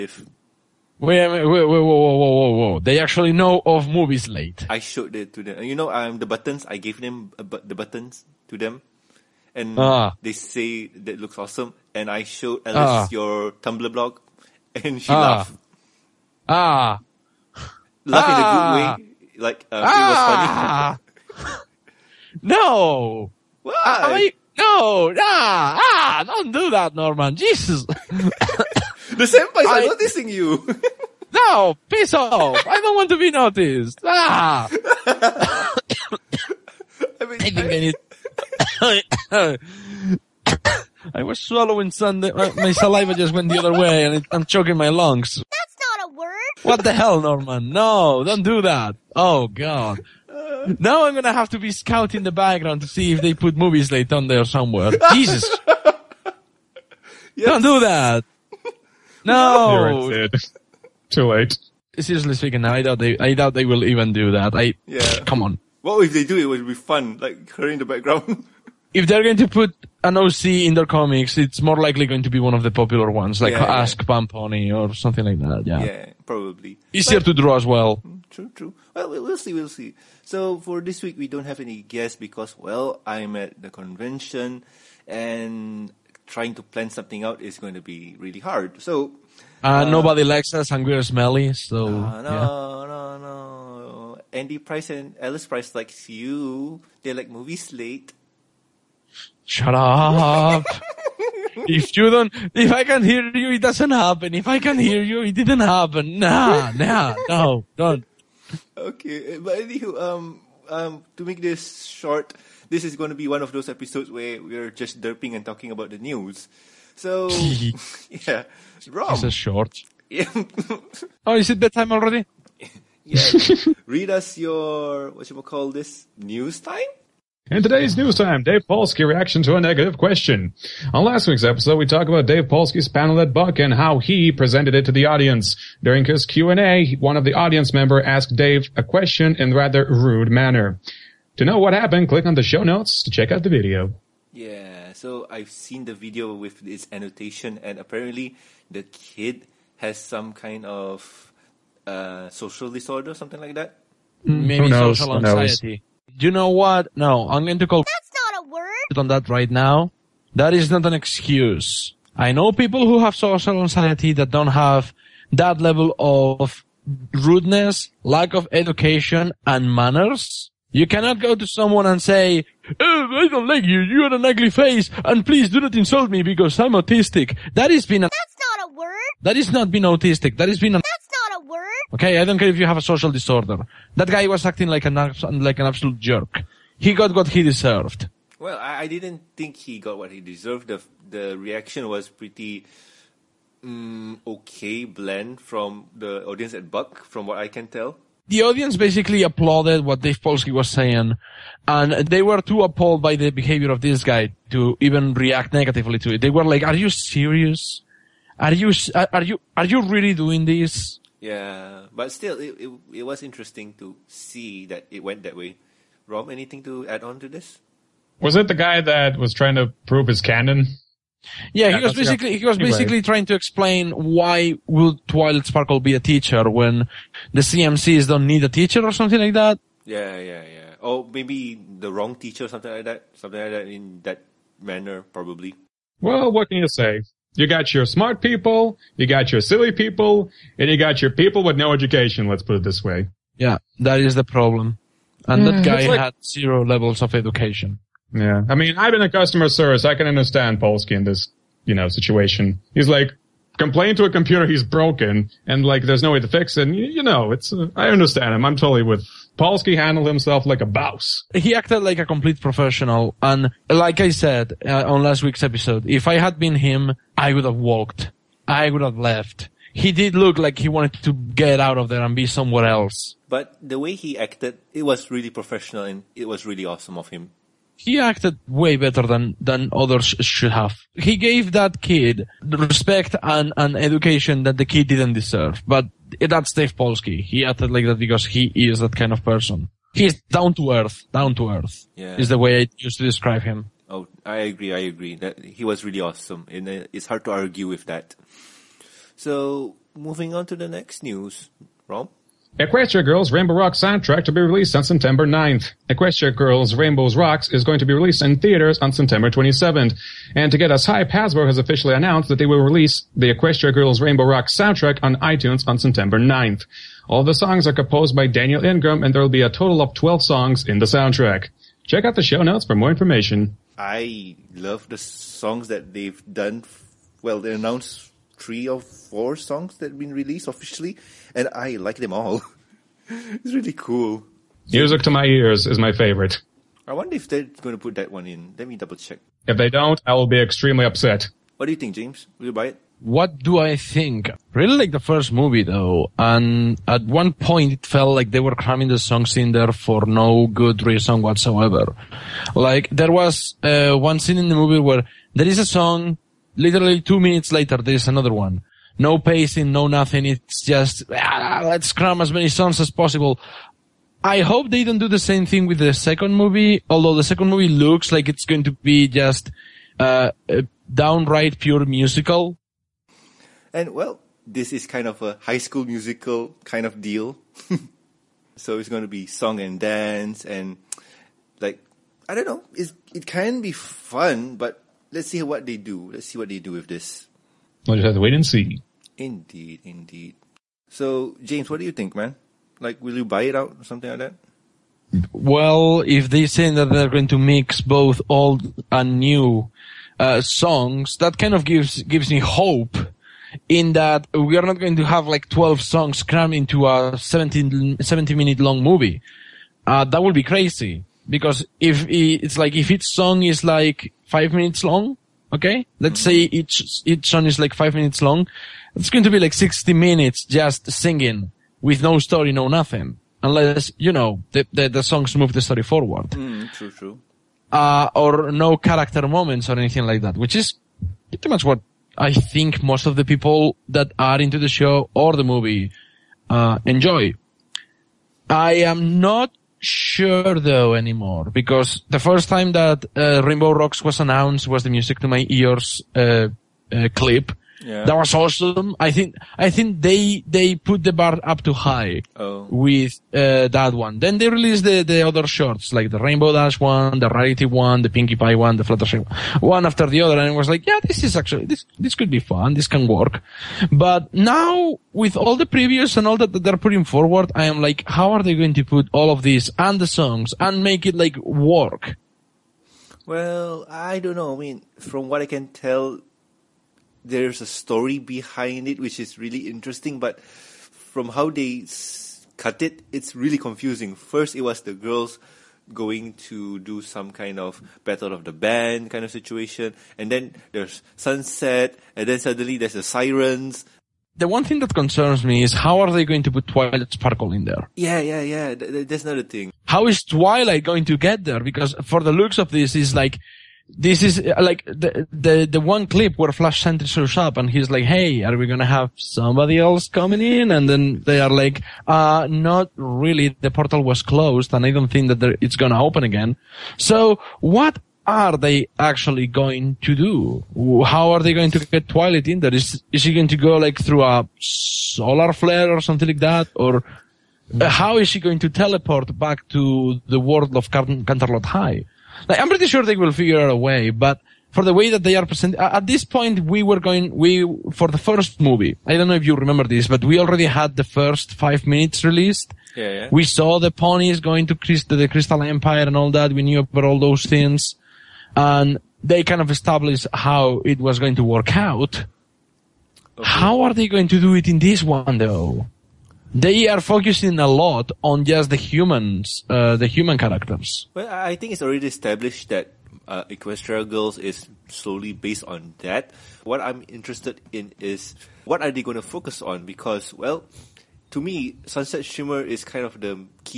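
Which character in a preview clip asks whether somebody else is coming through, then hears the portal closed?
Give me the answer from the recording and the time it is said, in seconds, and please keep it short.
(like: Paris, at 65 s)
Flash Sentry, at 506 s.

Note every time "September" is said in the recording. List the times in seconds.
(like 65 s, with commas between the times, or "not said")
304 s, 308 s, 315 s.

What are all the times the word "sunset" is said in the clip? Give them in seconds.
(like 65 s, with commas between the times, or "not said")
491 s, 571 s.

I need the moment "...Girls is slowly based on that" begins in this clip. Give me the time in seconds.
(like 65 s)
564 s.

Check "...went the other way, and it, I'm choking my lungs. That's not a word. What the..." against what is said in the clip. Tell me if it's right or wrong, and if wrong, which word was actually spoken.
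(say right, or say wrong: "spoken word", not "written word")
right.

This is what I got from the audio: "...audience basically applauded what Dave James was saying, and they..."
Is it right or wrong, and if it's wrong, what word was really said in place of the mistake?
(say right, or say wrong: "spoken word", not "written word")
wrong: "Polsky", not "James".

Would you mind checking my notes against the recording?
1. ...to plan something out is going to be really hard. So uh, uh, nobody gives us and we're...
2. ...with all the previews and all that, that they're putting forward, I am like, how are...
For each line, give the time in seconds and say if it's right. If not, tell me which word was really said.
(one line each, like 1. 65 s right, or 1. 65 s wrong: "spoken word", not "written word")
1. 86 s wrong: "likes", not "gives"
2. 465 s right.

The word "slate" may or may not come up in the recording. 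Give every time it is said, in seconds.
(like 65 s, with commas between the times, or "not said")
4 s, 53 s, 97 s.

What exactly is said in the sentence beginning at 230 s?
Or maybe the wrong teacher, something like that, something like that in that manner, probably.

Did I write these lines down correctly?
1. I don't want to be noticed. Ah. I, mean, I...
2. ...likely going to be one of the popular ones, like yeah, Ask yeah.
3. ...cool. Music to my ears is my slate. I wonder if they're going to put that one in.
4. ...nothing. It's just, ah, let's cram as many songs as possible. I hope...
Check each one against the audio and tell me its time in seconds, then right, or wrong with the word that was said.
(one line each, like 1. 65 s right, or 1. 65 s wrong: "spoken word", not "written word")
1. 32 s right
2. 71 s right
3. 333 s wrong: "favorite", not "slate"
4. 359 s right.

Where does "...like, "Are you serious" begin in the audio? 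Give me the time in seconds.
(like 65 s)
206 s.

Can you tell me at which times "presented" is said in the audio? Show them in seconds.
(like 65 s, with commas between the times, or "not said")
134 s, 535 s.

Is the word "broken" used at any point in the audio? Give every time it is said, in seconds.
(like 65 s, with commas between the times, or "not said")
254 s.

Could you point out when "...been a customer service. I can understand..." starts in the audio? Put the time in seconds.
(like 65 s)
248 s.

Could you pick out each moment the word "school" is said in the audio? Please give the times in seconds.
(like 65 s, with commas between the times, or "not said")
375 s.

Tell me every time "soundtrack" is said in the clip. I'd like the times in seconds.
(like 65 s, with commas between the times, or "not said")
303 s, 314 s, 320 s.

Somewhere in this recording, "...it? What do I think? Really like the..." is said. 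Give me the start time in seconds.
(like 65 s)
342 s.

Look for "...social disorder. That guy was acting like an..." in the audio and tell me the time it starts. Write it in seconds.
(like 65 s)
182 s.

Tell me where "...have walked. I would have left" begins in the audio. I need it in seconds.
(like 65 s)
267 s.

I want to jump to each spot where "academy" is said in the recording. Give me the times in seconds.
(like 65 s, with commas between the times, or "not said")
not said.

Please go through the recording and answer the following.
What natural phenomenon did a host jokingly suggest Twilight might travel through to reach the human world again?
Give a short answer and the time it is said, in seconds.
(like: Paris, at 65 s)
a solar flare, at 524 s.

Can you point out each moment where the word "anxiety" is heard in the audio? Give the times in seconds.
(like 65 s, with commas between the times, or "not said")
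155 s, 163 s.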